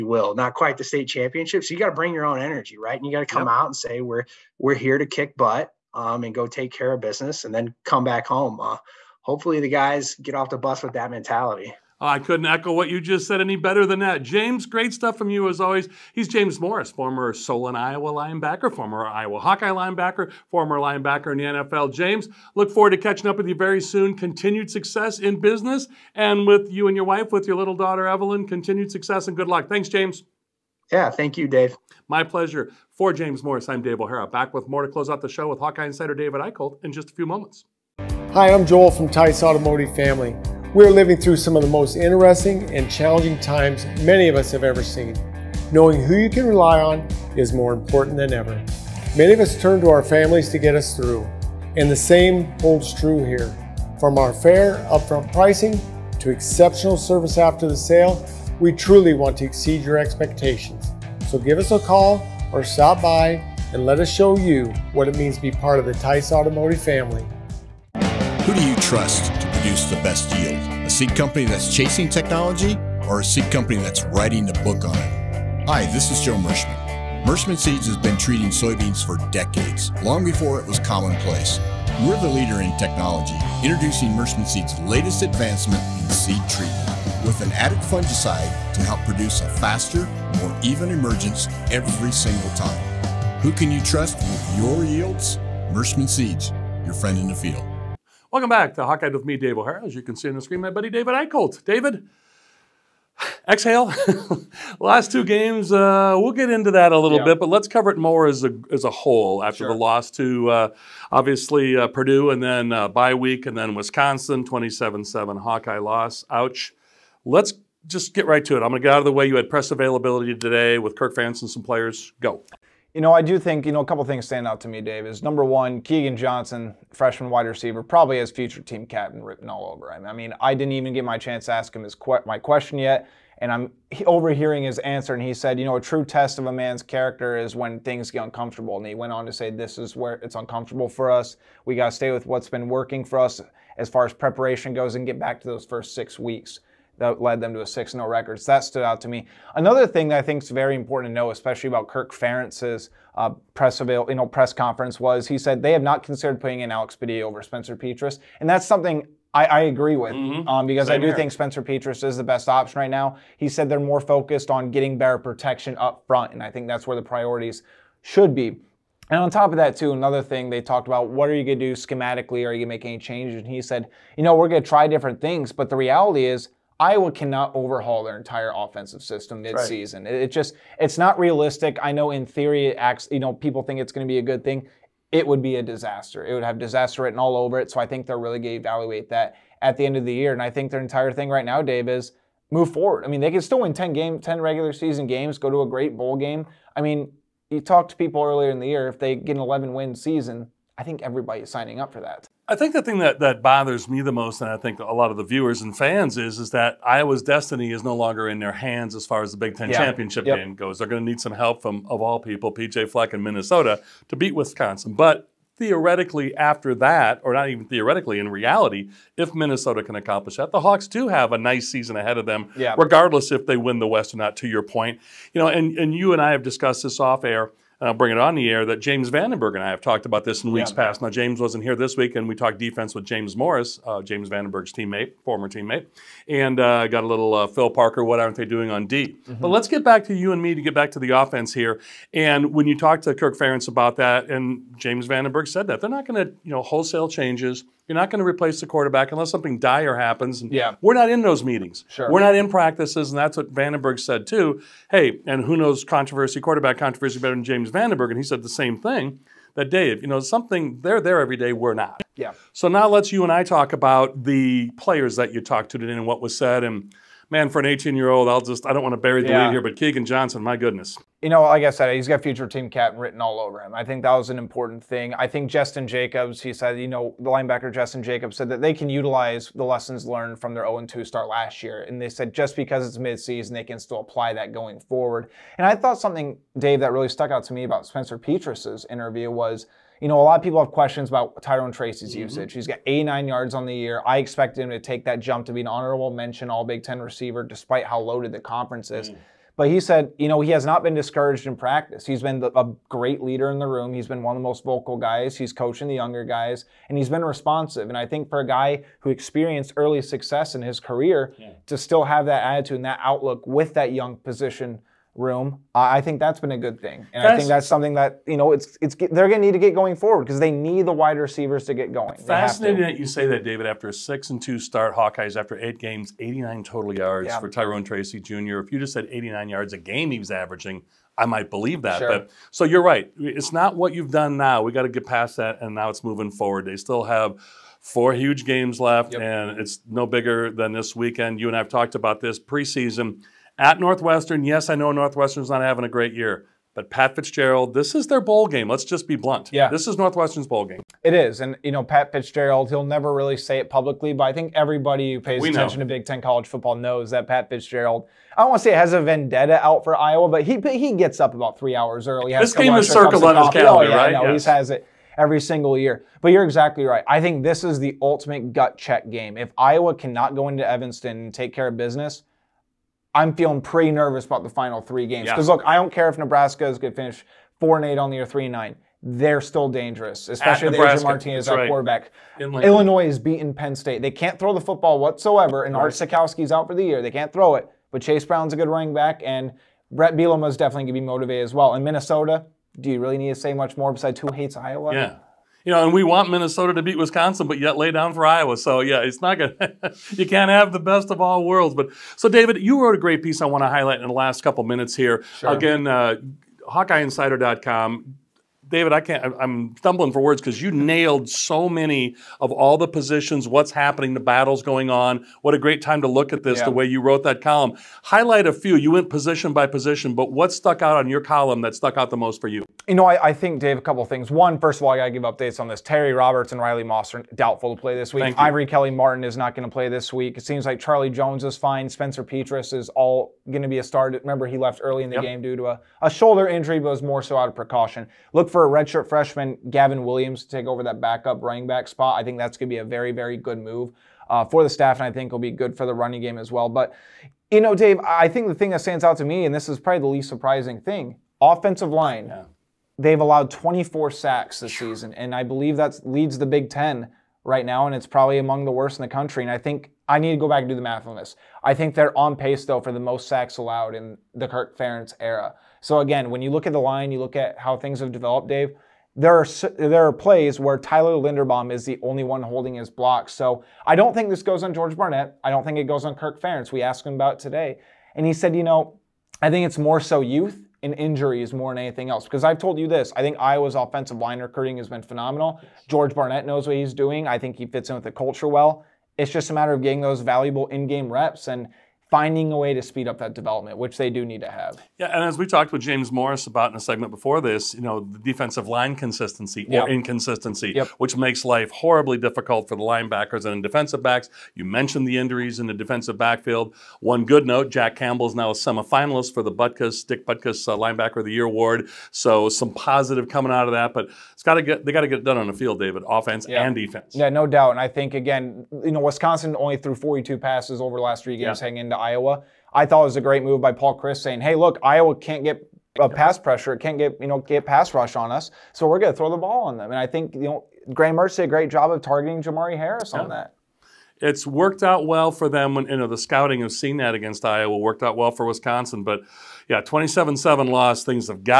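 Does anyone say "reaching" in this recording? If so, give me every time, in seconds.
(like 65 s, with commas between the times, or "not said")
not said.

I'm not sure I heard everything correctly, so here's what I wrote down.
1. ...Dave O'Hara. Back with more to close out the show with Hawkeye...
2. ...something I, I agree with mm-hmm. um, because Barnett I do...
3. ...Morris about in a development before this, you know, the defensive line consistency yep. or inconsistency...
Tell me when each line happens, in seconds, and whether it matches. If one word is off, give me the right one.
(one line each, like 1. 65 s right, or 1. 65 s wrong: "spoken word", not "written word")
1. 33 s right
2. 158 s wrong: "Same", not "Barnett"
3. 496 s wrong: "segment", not "development".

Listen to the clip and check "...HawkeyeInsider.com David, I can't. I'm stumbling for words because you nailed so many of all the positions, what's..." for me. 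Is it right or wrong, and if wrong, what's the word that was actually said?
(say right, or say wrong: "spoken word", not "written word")
right.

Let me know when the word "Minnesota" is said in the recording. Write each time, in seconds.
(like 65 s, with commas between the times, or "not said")
213 s, 219 s, 391 s, 396 s.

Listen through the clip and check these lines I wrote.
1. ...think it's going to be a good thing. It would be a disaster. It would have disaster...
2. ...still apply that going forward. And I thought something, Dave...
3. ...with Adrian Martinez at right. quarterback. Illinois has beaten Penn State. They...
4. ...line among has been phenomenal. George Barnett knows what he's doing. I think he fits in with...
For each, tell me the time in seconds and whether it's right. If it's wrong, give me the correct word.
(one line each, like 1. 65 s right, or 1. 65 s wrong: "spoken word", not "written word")
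1. 183 s right
2. 283 s right
3. 380 s right
4. 484 s wrong: "recruiting", not "among".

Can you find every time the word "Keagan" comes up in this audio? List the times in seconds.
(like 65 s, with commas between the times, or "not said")
125 s, 269 s.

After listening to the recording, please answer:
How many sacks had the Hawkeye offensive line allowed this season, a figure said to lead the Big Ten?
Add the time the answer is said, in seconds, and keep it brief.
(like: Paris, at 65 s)
24, at 453 s.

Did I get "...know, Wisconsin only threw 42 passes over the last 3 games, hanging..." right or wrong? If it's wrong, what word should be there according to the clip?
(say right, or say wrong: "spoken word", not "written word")
right.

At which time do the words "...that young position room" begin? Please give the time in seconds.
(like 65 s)
313 s.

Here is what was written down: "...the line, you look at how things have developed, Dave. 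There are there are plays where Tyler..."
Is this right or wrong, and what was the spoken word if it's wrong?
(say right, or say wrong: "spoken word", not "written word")
right.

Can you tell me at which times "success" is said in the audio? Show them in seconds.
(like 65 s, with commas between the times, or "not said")
24 s, 28 s, 310 s.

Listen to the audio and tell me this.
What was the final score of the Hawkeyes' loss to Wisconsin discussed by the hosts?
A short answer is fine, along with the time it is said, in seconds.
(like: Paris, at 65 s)
27-7, at 114 s.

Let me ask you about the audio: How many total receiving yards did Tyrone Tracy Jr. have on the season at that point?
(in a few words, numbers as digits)
89.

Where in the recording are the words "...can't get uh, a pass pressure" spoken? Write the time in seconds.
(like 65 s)
525 s.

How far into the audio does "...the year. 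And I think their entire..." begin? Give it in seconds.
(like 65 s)
190 s.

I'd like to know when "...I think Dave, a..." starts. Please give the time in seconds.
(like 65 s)
423 s.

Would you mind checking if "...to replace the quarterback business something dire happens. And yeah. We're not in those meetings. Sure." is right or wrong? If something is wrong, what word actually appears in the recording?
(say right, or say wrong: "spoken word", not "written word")
wrong: "unless", not "business".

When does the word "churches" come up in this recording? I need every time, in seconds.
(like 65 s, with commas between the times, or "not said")
not said.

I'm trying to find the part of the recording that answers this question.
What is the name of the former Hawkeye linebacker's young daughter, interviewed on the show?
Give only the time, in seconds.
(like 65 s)
28 s.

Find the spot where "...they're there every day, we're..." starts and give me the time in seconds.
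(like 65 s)
260 s.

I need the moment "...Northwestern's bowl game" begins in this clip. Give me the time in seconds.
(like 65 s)
349 s.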